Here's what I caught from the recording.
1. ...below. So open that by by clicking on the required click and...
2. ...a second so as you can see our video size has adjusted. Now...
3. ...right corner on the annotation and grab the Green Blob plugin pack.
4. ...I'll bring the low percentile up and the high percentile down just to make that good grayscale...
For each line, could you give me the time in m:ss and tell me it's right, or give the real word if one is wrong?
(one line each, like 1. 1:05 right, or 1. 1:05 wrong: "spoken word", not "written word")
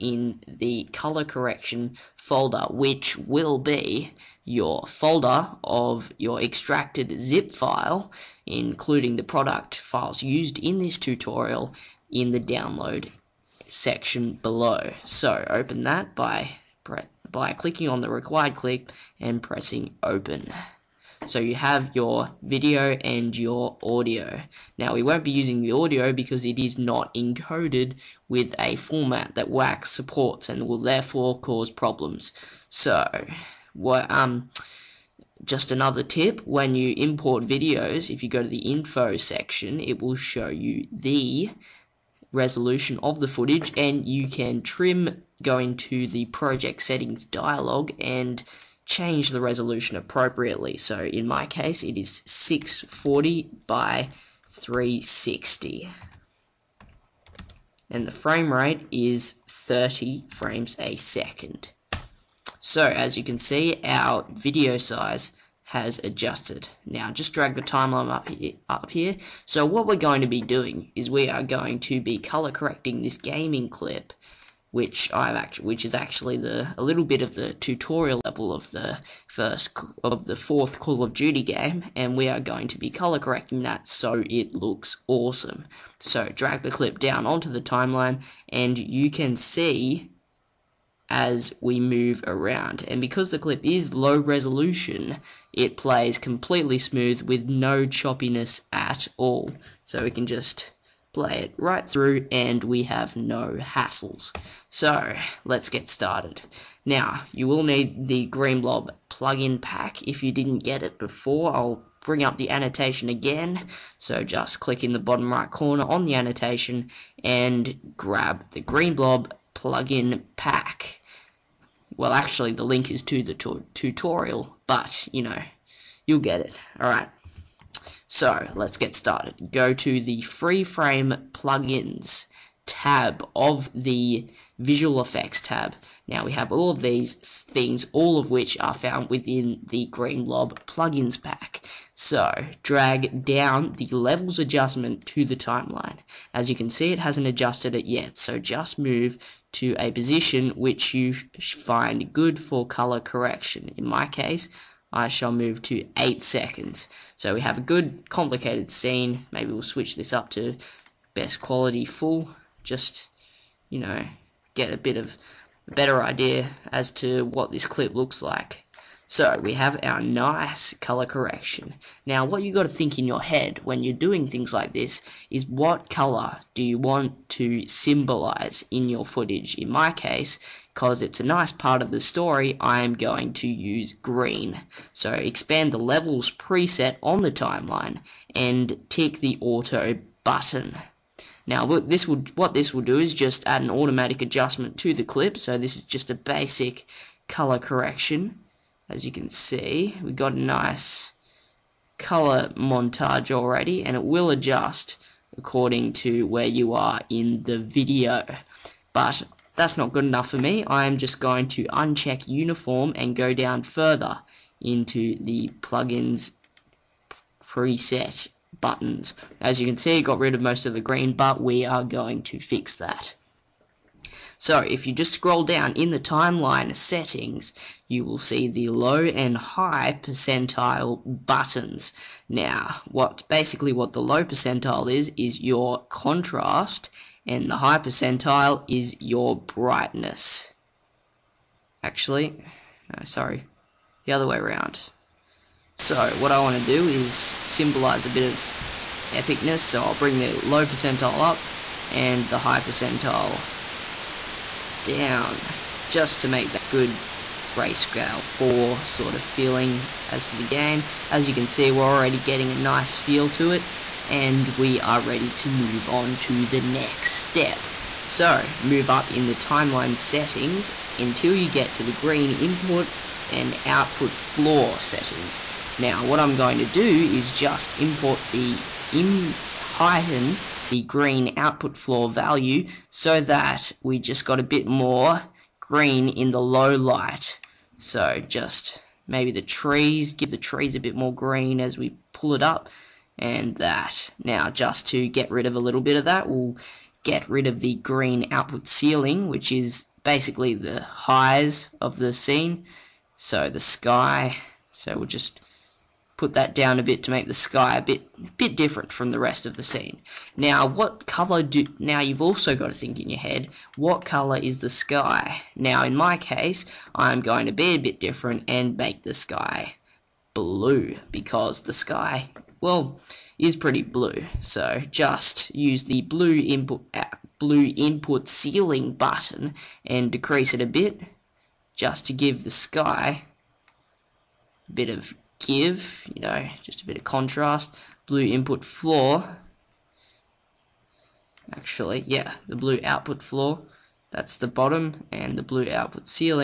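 1. 0:14 right
2. 1:00 right
3. 1:55 right
4. 4:09 right.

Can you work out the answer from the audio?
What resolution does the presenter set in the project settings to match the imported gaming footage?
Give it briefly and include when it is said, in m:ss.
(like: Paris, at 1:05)
640 by 360, at 0:52.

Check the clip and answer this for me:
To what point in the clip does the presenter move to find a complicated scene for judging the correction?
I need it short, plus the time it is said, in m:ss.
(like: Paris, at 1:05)
8 seconds, at 2:35.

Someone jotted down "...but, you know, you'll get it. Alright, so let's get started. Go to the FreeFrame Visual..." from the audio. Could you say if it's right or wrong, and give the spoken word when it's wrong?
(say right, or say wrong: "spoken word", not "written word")
wrong: "Plugins", not "Visual".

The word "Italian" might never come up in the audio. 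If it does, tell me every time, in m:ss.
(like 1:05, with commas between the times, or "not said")
not said.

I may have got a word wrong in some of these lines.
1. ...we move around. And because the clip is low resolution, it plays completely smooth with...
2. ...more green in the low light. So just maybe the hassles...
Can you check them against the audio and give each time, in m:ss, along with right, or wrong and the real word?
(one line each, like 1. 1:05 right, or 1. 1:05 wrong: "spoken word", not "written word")
1. 1:31 right
2. 4:44 wrong: "trees", not "hassles".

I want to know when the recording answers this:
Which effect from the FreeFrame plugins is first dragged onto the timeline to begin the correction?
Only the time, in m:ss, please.
2:23.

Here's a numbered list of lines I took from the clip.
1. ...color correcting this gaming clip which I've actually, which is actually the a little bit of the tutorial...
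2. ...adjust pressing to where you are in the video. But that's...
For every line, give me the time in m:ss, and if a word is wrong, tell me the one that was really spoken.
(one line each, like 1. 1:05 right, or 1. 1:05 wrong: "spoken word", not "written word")
1. 1:12 right
2. 3:24 wrong: "according", not "pressing".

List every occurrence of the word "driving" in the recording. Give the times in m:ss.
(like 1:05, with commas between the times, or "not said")
not said.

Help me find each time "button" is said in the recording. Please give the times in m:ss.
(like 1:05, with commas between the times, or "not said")
3:10, 3:38, 3:51, 5:28.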